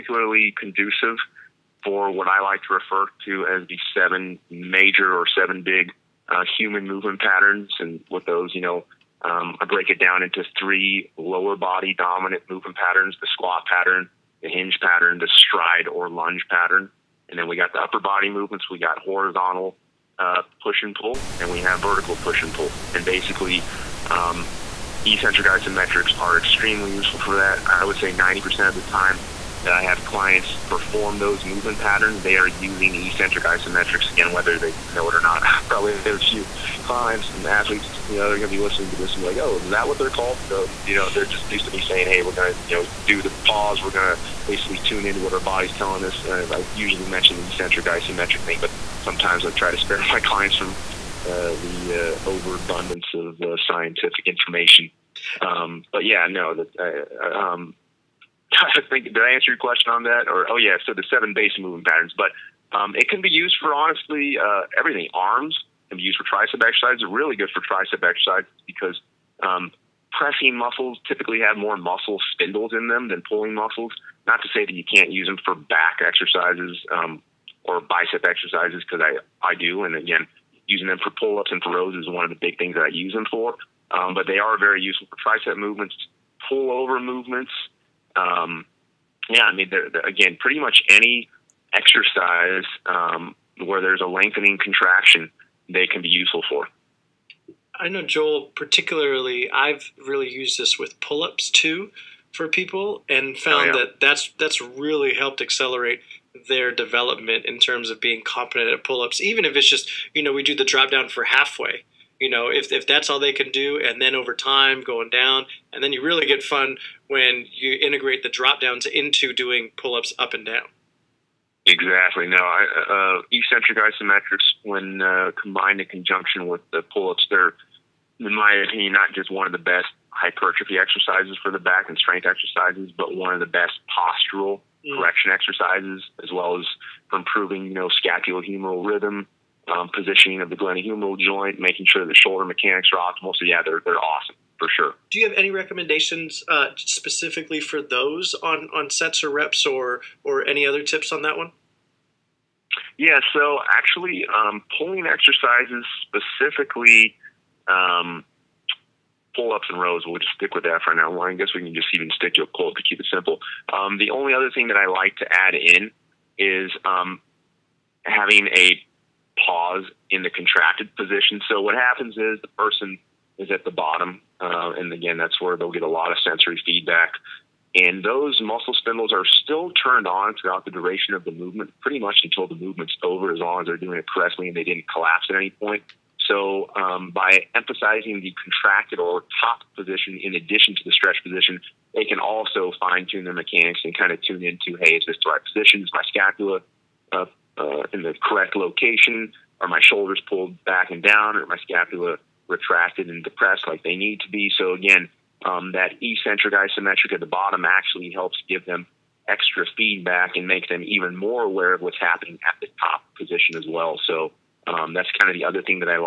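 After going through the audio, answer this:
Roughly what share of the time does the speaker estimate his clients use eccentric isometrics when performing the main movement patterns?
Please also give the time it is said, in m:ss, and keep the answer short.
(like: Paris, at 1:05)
90%, at 0:28.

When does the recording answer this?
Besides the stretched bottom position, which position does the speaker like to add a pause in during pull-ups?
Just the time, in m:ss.
2:50.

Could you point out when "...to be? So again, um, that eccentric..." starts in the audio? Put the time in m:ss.
3:24.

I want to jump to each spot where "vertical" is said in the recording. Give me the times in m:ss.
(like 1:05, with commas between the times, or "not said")
0:21.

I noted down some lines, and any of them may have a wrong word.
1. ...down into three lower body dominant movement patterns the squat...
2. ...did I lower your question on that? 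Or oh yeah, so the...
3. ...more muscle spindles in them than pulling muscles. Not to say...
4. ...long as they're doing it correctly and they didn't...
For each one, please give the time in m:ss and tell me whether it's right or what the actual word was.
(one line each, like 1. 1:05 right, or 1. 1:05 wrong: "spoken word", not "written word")
1. 0:09 right
2. 0:59 wrong: "answer", not "lower"
3. 1:11 right
4. 3:03 right.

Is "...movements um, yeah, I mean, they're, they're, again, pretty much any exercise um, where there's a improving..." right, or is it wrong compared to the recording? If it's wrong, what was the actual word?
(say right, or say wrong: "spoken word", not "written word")
wrong: "lengthening", not "improving".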